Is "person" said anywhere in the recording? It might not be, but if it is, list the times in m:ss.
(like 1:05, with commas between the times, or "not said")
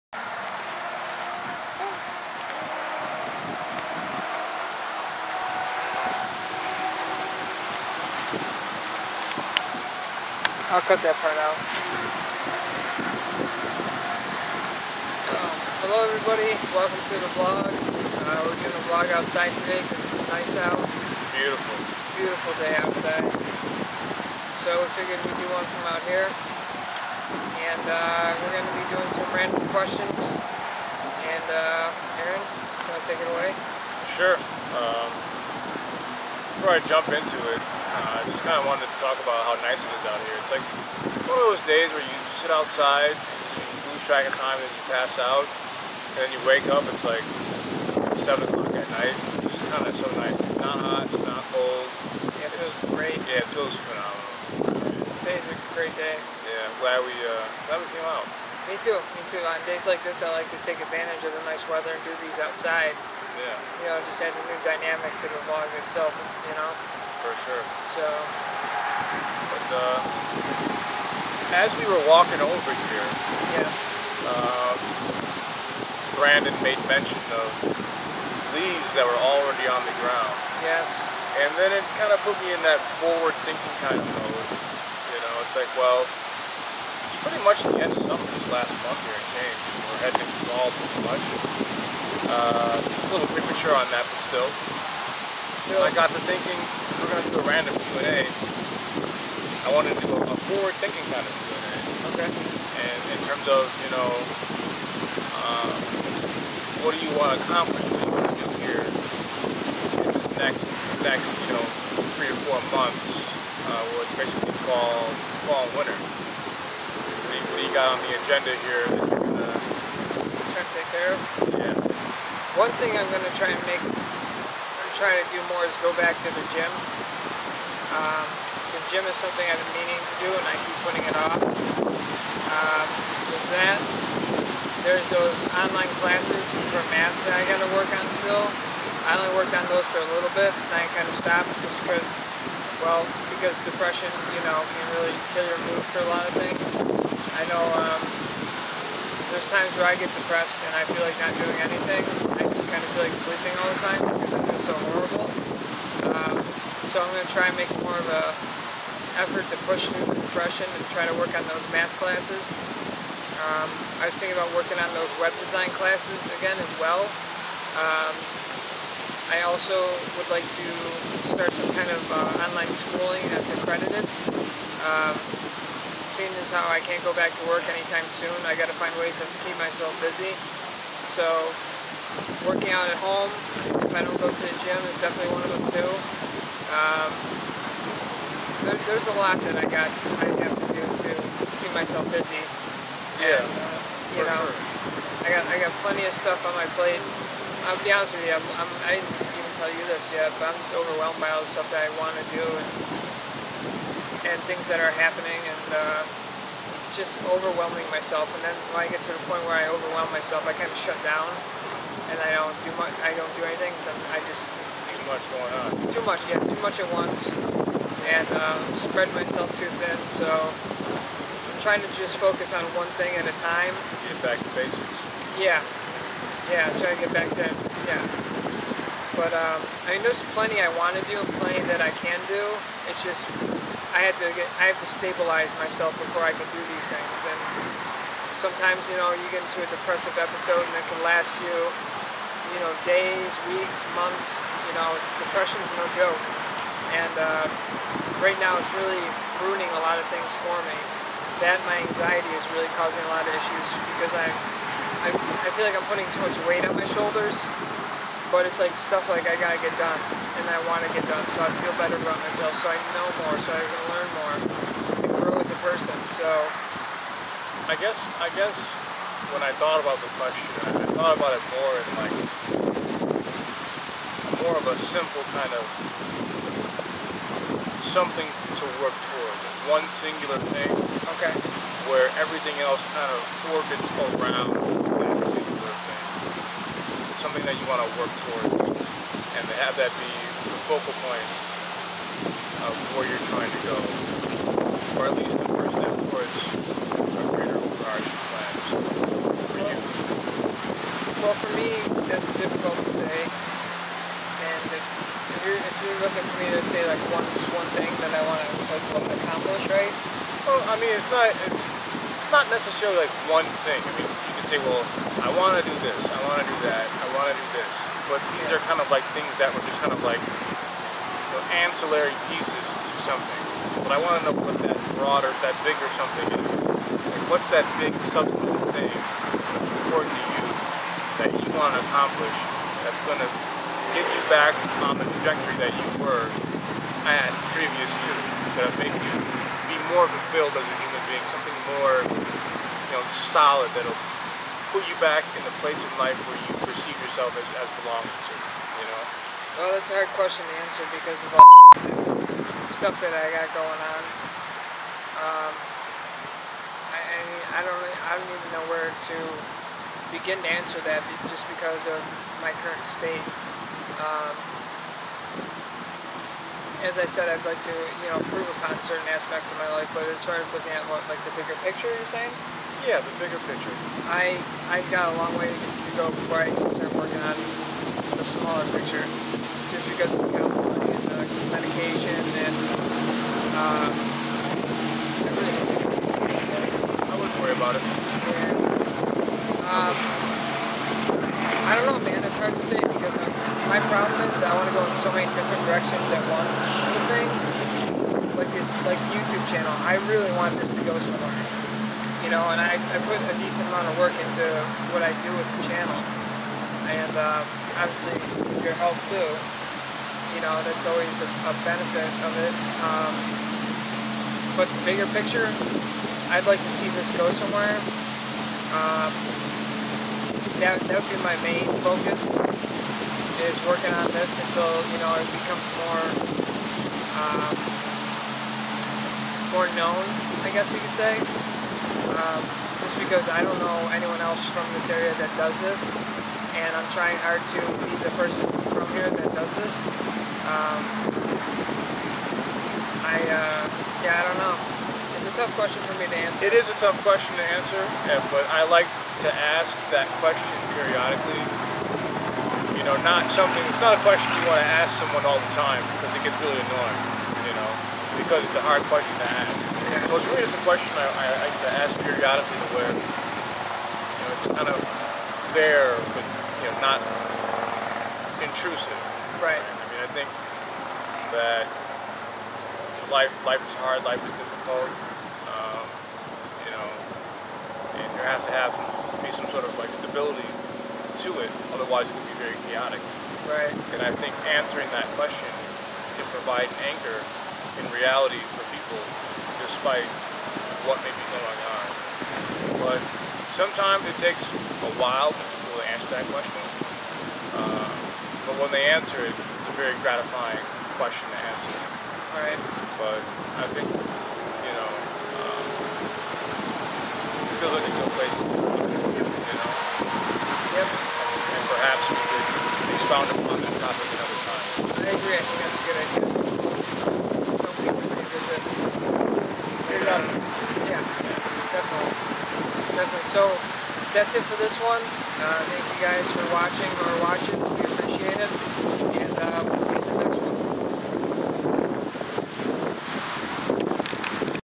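4:25, 7:18.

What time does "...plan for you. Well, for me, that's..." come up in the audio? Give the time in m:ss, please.
4:58.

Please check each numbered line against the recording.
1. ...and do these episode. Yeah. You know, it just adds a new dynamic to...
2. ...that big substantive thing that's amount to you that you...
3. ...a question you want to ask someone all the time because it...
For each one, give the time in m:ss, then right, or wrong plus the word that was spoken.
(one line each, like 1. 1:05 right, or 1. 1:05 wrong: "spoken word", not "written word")
1. 1:01 wrong: "outside", not "episode"
2. 5:27 wrong: "important", not "amount"
3. 7:33 right.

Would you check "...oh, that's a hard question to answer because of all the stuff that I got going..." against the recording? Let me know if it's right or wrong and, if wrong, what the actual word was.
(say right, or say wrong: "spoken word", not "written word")
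right.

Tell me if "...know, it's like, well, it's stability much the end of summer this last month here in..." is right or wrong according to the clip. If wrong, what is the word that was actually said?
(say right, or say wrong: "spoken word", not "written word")
wrong: "pretty", not "stability".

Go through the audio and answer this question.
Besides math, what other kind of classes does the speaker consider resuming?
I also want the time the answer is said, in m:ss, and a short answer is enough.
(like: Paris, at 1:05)
Web design, at 2:45.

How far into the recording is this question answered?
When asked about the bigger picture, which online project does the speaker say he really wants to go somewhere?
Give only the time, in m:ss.
6:39.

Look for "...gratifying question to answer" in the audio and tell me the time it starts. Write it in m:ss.
8:20.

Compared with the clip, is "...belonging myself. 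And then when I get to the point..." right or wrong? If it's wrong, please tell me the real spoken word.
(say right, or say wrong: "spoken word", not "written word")
wrong: "overwhelming", not "belonging".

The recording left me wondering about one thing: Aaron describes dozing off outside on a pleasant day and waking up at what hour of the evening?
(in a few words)
7 o'clock.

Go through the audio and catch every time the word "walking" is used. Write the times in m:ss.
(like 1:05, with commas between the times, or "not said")
1:12.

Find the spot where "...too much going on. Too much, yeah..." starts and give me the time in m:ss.
3:34.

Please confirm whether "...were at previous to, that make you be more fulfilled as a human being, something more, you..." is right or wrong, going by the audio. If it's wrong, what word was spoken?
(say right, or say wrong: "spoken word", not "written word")
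right.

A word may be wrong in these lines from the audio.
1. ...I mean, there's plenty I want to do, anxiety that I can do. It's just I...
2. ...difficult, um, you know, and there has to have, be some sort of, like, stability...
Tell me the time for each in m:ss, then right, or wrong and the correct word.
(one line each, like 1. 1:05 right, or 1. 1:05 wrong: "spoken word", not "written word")
1. 3:49 wrong: "plenty", not "anxiety"
2. 7:54 right.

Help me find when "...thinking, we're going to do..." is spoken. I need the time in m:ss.
1:36.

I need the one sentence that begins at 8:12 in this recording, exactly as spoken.
But sometimes it takes a while for people to answer that question.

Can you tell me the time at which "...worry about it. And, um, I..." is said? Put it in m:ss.
6:27.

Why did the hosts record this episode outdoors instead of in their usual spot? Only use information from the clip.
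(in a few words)
Because it's nice out.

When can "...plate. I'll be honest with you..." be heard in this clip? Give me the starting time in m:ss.
3:16.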